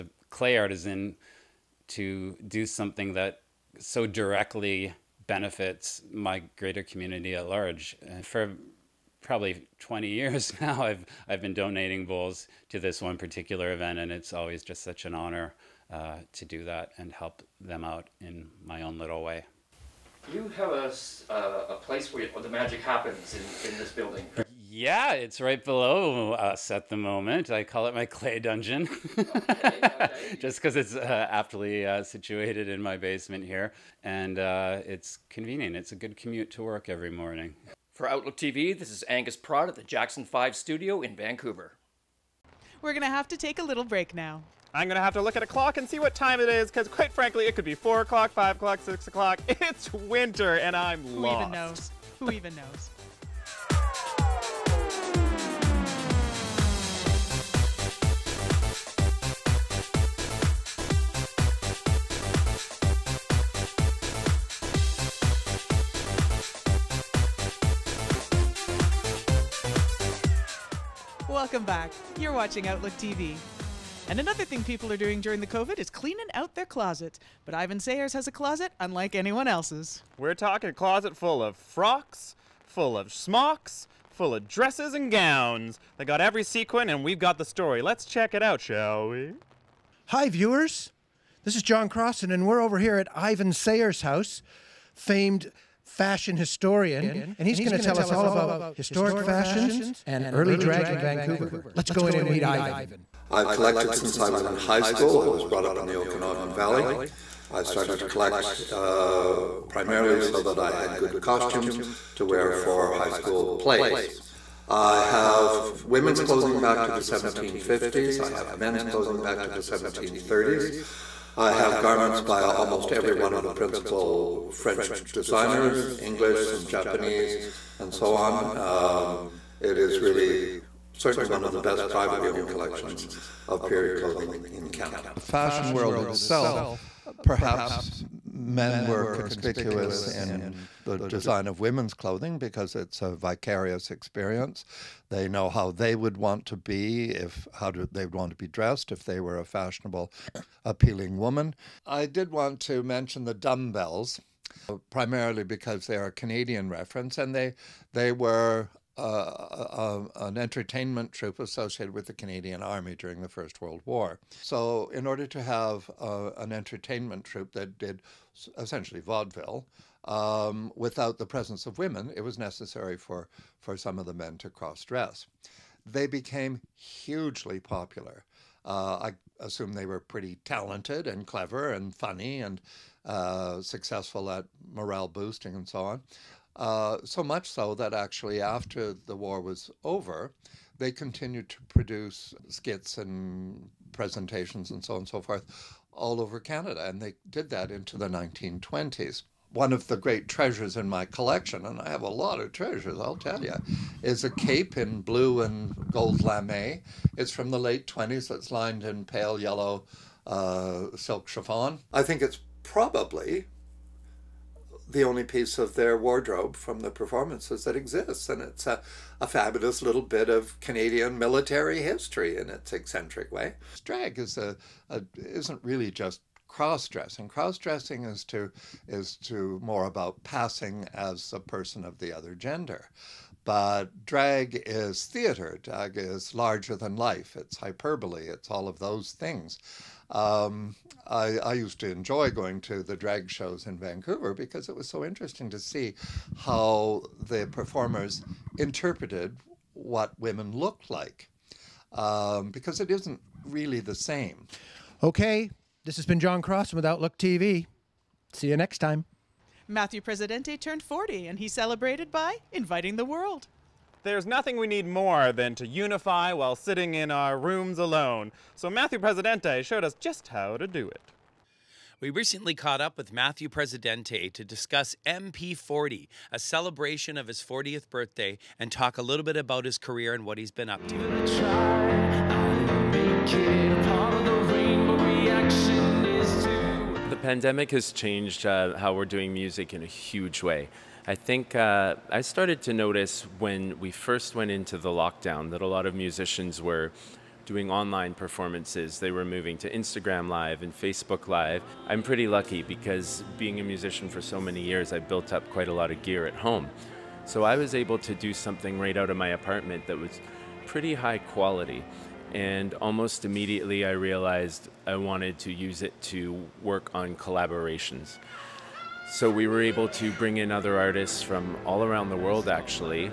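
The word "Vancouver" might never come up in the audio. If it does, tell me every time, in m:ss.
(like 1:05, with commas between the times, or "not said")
0:41, 1:40, 4:03.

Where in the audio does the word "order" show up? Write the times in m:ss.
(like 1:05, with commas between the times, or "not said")
2:45.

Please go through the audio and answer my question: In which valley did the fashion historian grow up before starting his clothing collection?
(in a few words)
Okanagan Valley.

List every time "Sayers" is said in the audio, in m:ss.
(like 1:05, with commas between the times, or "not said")
1:17, 1:33.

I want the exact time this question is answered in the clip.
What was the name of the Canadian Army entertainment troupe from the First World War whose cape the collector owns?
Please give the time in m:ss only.
2:33.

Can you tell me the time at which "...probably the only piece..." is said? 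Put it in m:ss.
3:32.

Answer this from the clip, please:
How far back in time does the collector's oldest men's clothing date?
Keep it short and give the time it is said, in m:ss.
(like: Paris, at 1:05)
1730s, at 1:59.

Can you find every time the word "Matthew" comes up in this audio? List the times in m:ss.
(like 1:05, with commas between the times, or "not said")
4:19, 4:28, 4:33.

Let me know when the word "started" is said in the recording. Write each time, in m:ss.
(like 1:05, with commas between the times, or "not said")
1:47, 4:52.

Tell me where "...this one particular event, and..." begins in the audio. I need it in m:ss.
0:12.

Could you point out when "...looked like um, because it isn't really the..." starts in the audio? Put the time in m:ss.
4:10.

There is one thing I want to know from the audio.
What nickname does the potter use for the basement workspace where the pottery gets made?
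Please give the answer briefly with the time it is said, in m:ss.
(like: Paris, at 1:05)
clay dungeon, at 0:28.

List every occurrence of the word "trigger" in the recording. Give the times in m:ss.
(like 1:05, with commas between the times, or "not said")
not said.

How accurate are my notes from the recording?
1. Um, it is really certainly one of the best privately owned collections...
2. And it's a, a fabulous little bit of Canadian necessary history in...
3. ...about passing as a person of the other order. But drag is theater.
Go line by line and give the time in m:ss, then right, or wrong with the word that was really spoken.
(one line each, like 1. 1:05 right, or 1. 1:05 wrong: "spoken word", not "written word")
1. 2:08 right
2. 3:38 wrong: "military", not "necessary"
3. 3:49 wrong: "gender", not "order".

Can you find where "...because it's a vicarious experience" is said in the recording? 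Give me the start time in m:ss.
2:22.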